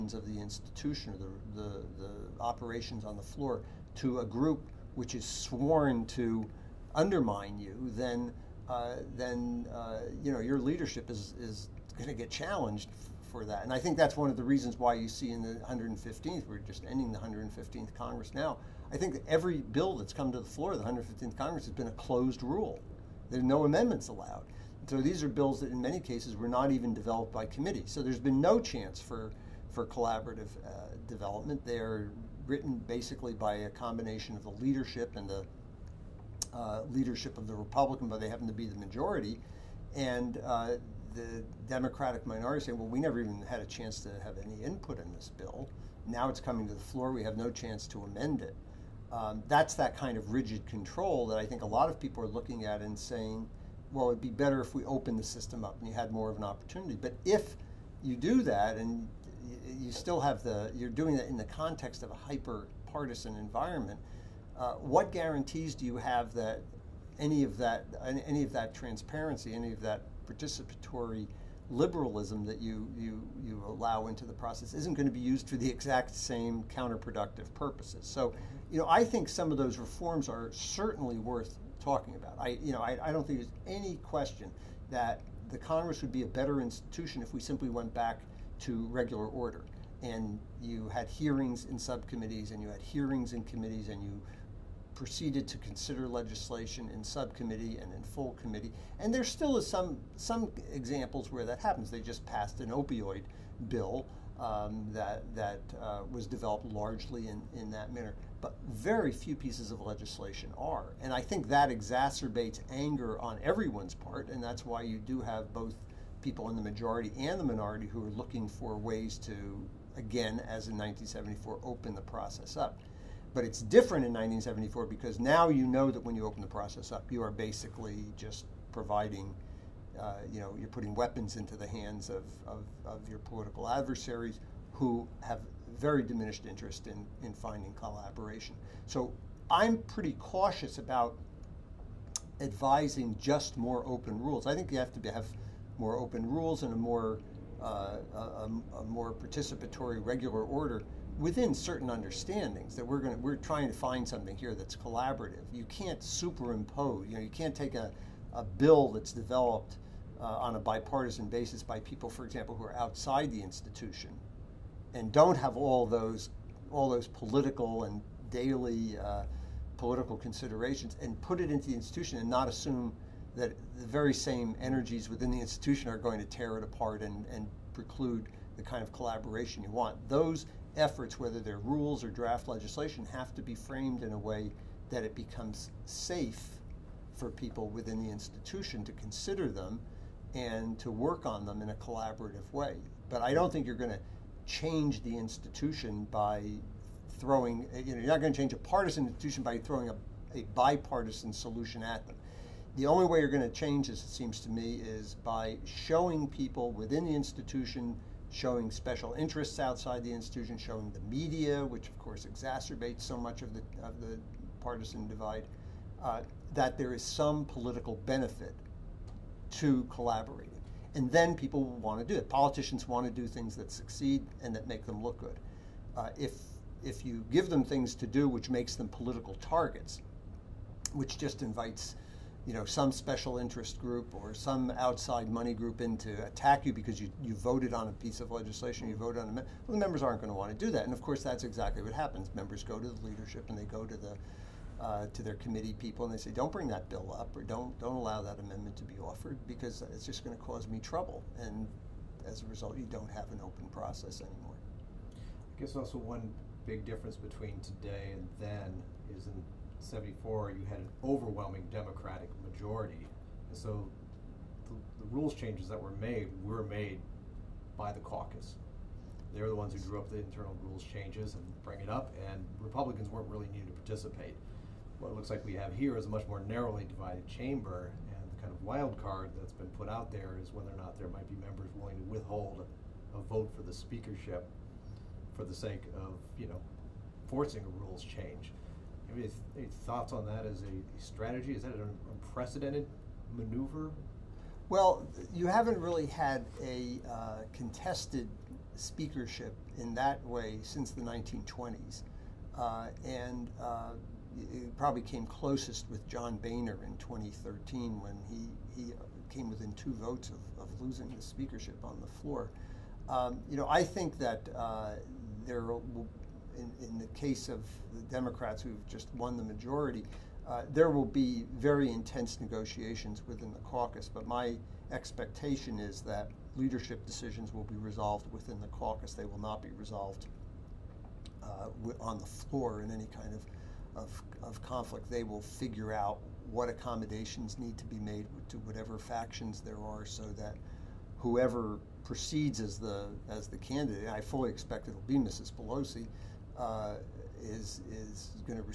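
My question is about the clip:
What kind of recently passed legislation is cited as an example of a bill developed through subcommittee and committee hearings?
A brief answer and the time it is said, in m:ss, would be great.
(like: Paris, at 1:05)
Opioid bill, at 1:42.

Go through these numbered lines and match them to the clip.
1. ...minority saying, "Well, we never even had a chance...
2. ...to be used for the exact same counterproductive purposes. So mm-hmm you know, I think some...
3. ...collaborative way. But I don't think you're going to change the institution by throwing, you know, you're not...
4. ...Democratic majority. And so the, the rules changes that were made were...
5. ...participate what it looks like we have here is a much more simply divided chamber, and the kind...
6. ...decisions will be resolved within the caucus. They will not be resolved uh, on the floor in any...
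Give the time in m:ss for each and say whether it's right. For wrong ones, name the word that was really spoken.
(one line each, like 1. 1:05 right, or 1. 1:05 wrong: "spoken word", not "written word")
1. 0:42 right
2. 1:15 right
3. 3:11 right
4. 4:21 right
5. 4:33 wrong: "narrowly", not "simply"
6. 5:27 right.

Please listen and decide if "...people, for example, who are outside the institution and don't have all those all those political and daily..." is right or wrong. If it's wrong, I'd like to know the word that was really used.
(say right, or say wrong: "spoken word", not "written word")
right.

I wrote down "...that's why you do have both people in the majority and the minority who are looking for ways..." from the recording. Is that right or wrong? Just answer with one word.
right.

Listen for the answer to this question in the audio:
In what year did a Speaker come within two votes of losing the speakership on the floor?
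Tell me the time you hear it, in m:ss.
5:06.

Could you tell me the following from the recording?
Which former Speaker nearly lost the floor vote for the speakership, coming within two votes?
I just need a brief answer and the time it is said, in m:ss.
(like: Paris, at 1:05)
John Boehner, at 5:06.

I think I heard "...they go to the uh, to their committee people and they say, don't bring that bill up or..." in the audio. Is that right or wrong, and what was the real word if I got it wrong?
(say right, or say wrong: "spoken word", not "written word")
right.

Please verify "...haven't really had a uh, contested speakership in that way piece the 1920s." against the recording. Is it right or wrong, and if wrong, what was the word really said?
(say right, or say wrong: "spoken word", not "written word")
wrong: "since", not "piece".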